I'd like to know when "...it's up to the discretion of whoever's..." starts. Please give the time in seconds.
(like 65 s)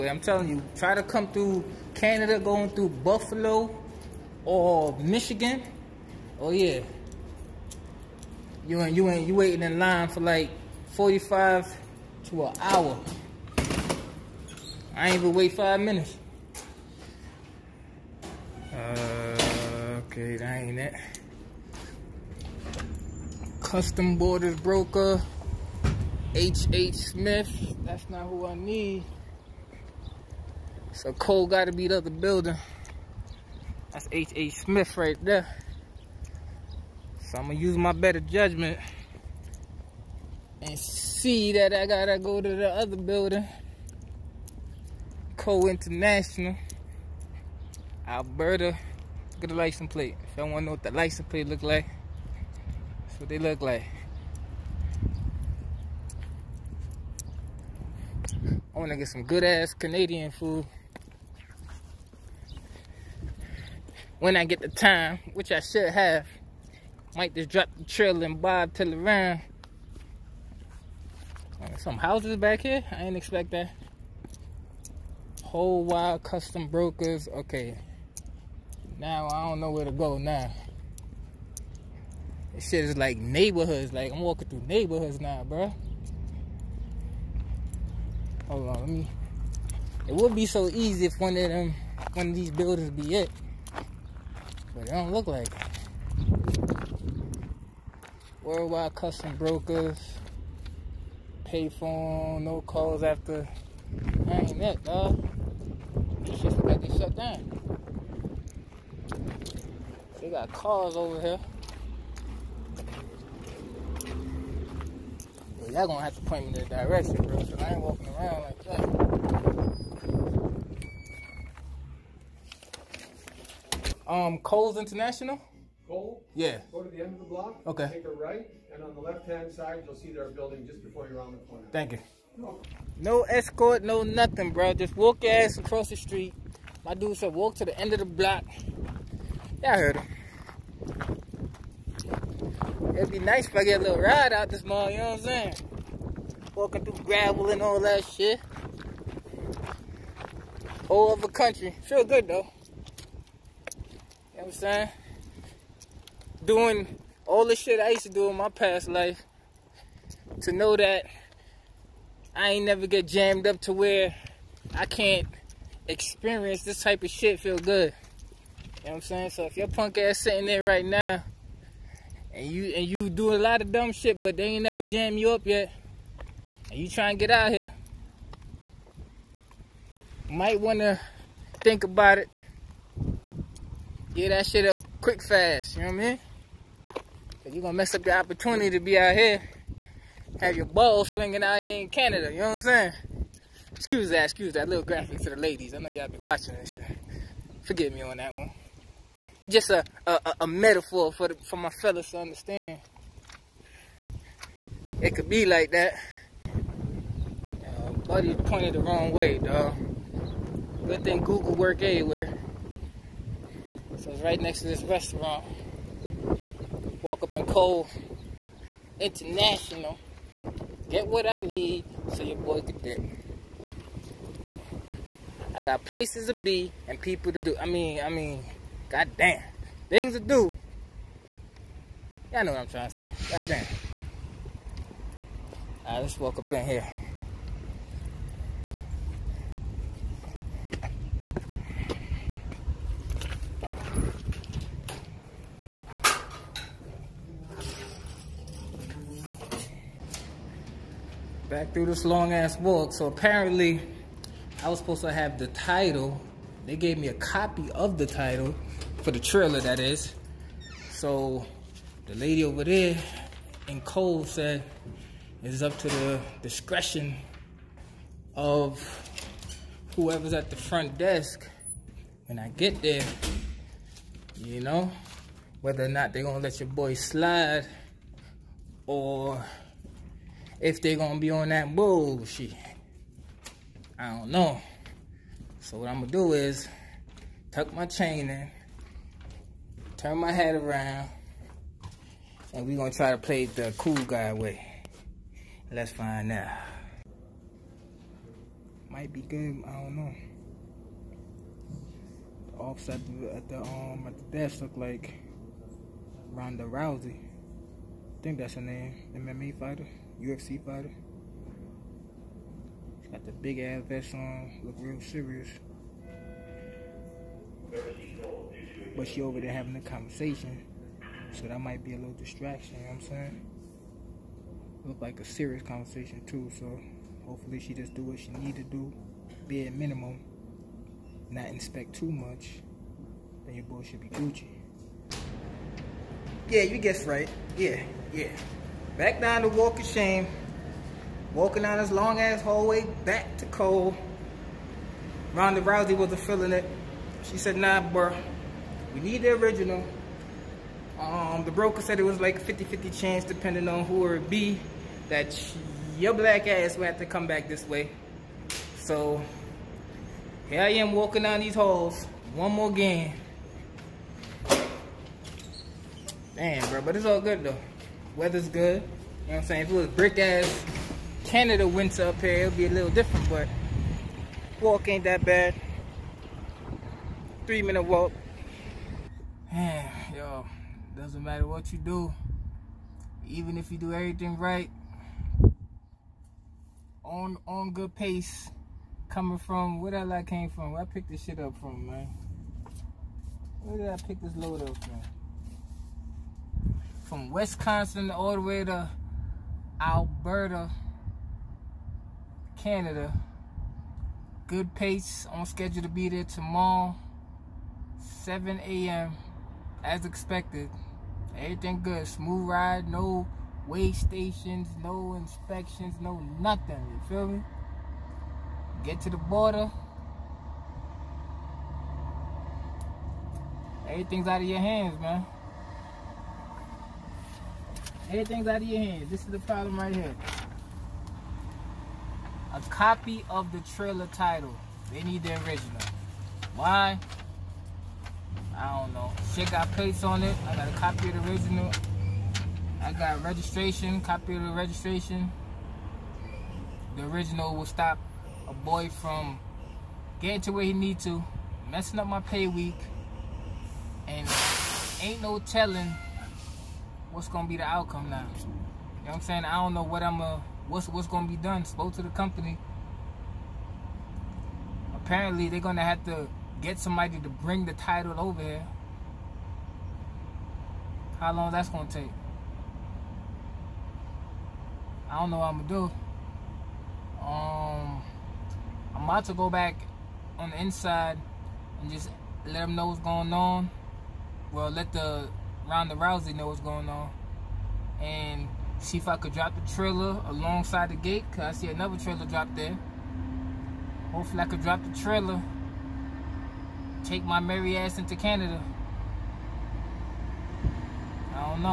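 265 s.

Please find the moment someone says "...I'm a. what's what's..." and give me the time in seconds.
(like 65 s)
460 s.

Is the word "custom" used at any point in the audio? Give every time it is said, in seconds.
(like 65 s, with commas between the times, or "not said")
23 s, 76 s, 98 s.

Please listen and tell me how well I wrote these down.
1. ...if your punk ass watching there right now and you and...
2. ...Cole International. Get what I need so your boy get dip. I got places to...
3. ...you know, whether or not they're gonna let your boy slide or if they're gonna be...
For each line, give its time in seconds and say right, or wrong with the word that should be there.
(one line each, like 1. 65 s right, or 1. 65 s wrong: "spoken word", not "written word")
1. 169 s wrong: "sitting", not "watching"
2. 217 s right
3. 274 s right.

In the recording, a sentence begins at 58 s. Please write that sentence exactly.
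I want to get some good ass Canadian food.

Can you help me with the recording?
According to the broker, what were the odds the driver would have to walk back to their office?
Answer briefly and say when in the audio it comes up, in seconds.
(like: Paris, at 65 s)
50-50, at 352 s.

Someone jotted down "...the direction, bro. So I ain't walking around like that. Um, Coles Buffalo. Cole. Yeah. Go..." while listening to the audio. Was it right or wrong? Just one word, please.
wrong.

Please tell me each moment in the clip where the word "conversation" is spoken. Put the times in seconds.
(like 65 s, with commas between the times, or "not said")
319 s, 325 s.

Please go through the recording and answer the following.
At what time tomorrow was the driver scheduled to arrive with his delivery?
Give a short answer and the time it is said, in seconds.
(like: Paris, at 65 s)
7 a.m., at 408 s.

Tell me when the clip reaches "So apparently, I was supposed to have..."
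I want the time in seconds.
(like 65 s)
252 s.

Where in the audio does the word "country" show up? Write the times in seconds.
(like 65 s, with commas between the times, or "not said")
151 s.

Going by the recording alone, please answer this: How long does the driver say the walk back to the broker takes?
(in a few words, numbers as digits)
3 minutes.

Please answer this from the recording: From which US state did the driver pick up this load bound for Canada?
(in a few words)
Wisconsin.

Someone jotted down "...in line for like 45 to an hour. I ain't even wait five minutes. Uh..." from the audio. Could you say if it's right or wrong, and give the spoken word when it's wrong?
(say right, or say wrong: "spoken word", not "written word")
right.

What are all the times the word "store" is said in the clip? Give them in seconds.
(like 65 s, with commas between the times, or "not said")
not said.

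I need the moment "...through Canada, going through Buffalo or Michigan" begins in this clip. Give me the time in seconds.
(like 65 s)
1 s.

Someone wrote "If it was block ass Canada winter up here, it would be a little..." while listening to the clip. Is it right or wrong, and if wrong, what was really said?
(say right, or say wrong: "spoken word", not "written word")
wrong: "brick", not "block".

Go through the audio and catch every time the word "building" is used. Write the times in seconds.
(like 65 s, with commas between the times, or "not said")
32 s, 42 s, 92 s, 130 s.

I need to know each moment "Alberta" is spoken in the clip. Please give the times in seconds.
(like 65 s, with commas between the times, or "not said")
48 s, 399 s.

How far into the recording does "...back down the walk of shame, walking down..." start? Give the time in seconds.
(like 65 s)
338 s.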